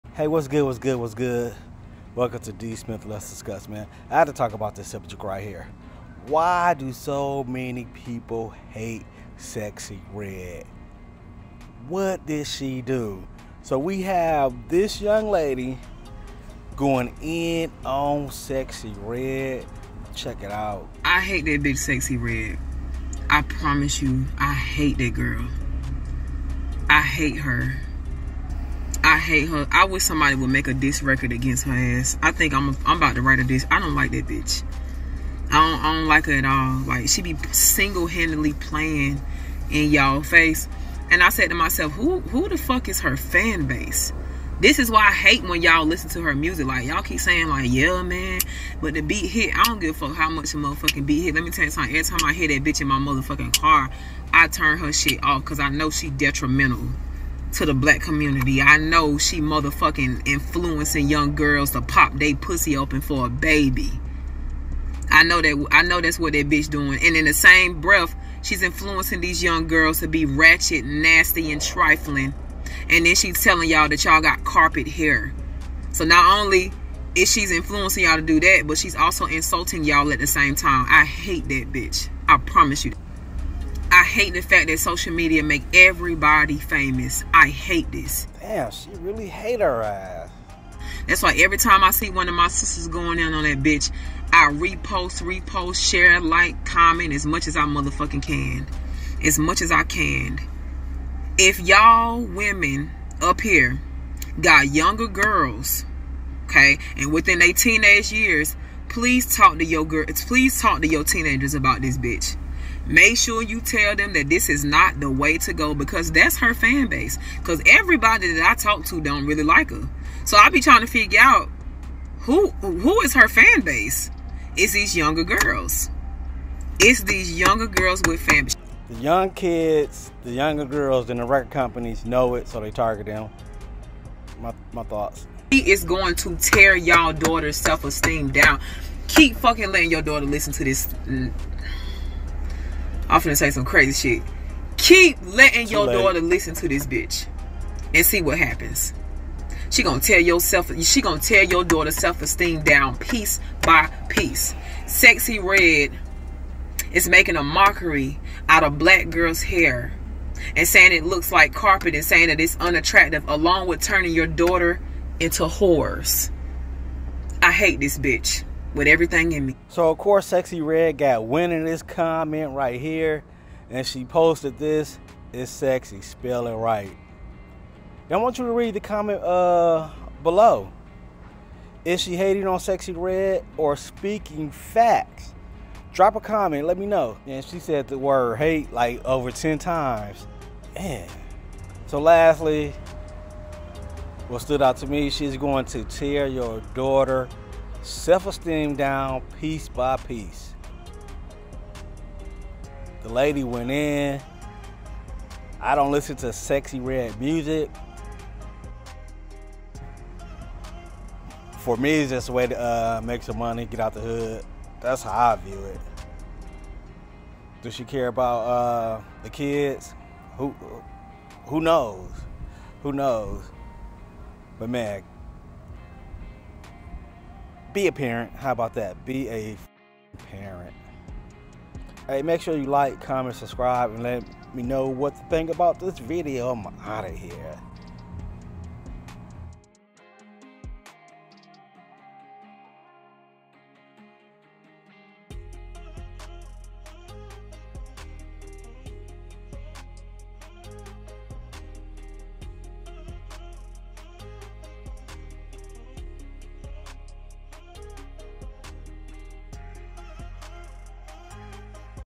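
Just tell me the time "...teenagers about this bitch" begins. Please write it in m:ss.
1:51.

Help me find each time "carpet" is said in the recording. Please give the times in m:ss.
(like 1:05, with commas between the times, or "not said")
1:14, 2:41.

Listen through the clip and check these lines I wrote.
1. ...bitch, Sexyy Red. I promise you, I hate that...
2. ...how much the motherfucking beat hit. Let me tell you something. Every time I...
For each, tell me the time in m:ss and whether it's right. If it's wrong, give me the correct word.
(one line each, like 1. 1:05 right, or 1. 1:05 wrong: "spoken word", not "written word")
1. 0:21 right
2. 0:50 right.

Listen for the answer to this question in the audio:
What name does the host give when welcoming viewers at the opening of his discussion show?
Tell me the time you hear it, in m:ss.
0:02.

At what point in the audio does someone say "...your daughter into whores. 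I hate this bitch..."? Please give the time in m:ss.
2:44.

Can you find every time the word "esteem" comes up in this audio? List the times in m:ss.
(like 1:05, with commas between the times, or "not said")
2:17, 2:31, 3:18.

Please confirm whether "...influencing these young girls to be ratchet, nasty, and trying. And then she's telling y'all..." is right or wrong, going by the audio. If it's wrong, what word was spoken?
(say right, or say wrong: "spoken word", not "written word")
wrong: "trifling", not "trying".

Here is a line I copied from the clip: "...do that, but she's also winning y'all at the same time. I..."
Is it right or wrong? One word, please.
wrong.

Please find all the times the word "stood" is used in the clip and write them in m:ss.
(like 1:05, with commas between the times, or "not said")
3:14.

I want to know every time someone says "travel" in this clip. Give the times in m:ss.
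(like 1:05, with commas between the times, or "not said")
not said.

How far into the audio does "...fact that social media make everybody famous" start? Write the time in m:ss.
1:24.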